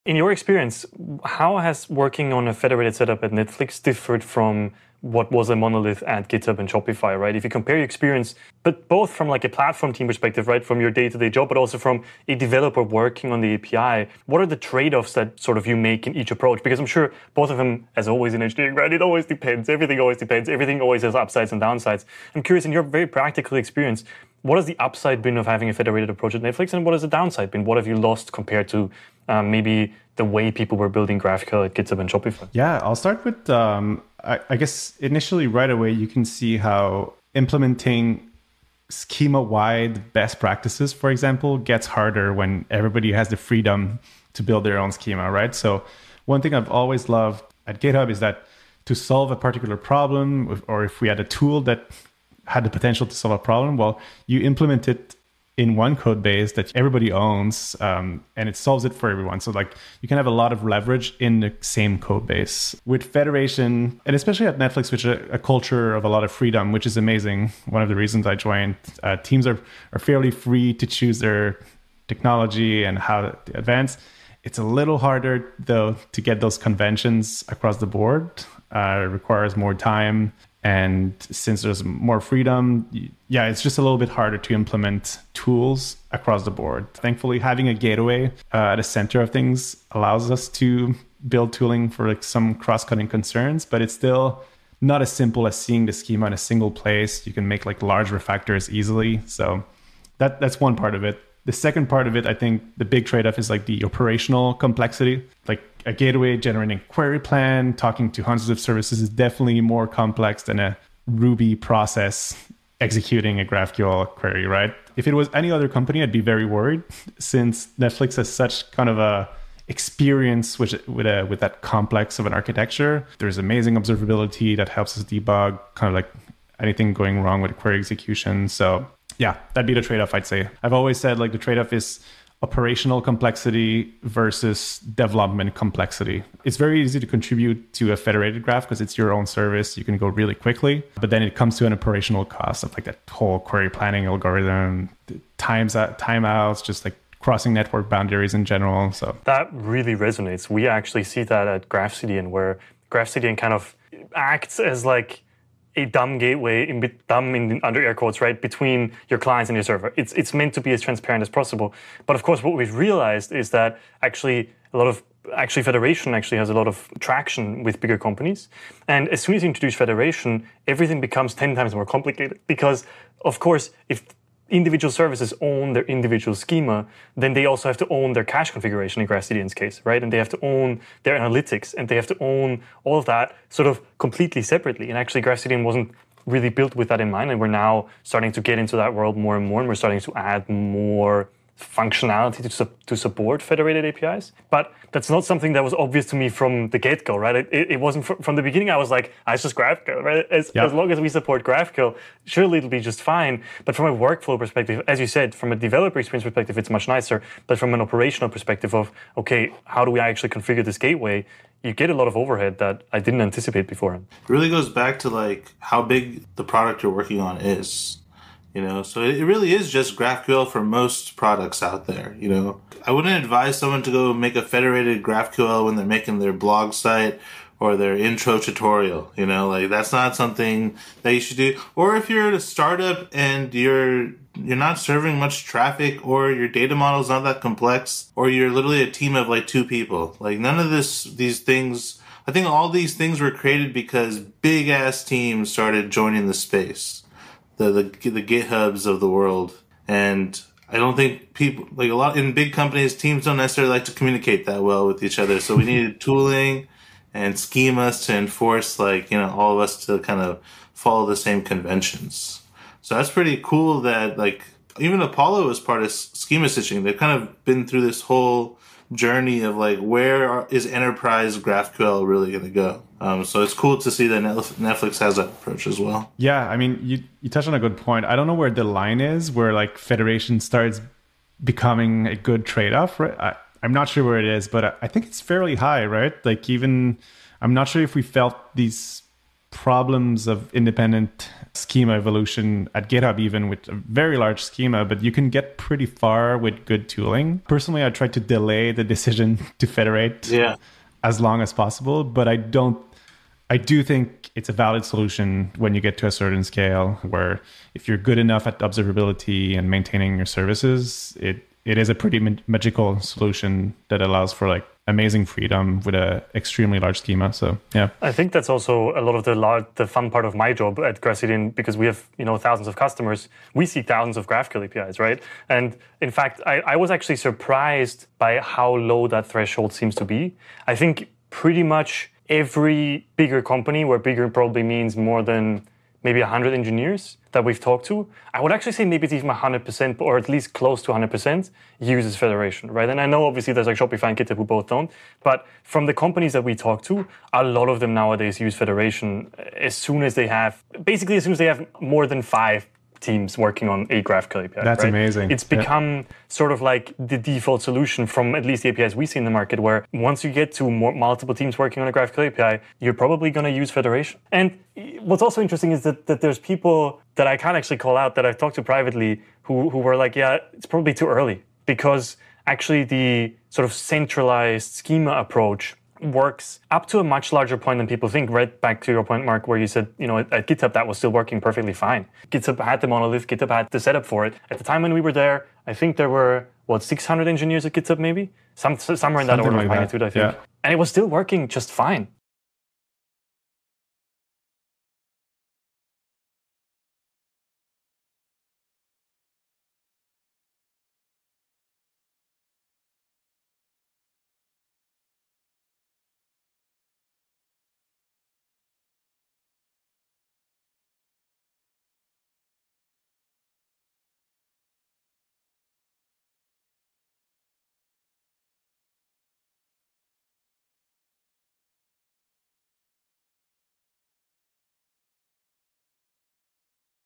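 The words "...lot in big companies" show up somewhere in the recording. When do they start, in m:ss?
4:11.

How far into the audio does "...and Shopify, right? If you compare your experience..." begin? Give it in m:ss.
0:06.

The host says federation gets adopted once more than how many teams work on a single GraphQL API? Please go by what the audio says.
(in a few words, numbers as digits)
5 teams.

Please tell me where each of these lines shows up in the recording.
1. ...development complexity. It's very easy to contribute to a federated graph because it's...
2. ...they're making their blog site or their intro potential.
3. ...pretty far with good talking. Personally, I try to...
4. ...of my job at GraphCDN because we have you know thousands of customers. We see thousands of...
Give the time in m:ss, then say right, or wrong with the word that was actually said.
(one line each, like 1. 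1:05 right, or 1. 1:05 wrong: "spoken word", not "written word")
1. 2:14 right
2. 3:45 wrong: "tutorial", not "potential"
3. 4:55 wrong: "tooling", not "talking"
4. 5:20 right.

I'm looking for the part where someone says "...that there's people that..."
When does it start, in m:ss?
6:06.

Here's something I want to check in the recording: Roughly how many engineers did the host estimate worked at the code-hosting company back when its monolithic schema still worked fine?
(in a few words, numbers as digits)
600.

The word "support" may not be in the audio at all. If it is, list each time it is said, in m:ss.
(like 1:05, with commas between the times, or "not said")
3:12, 3:21.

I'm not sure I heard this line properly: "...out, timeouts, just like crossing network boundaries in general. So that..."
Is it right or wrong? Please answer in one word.
right.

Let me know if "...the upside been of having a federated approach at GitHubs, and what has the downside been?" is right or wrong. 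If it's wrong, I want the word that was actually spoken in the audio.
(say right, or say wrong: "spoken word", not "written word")
wrong: "Netflix", not "GitHubs".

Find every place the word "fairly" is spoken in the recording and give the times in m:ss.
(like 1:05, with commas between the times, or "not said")
1:09, 4:45.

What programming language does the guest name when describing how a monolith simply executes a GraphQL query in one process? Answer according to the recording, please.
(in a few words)
Ruby.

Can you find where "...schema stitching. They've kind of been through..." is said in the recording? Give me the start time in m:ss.
4:25.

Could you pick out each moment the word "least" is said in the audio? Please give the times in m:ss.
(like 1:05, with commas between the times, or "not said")
5:40, 5:58.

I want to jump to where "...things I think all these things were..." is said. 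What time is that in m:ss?
4:01.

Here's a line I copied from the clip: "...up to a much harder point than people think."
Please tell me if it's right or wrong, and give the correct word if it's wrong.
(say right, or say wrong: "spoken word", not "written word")
wrong: "larger", not "harder".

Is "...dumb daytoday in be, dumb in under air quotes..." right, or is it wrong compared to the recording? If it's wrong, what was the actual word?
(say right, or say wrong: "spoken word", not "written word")
wrong: "gateway", not "daytoday".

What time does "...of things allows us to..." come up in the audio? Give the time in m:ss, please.
1:29.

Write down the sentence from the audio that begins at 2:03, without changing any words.
There's amazing observability that helps us debug kind of like anything going wrong with query execution.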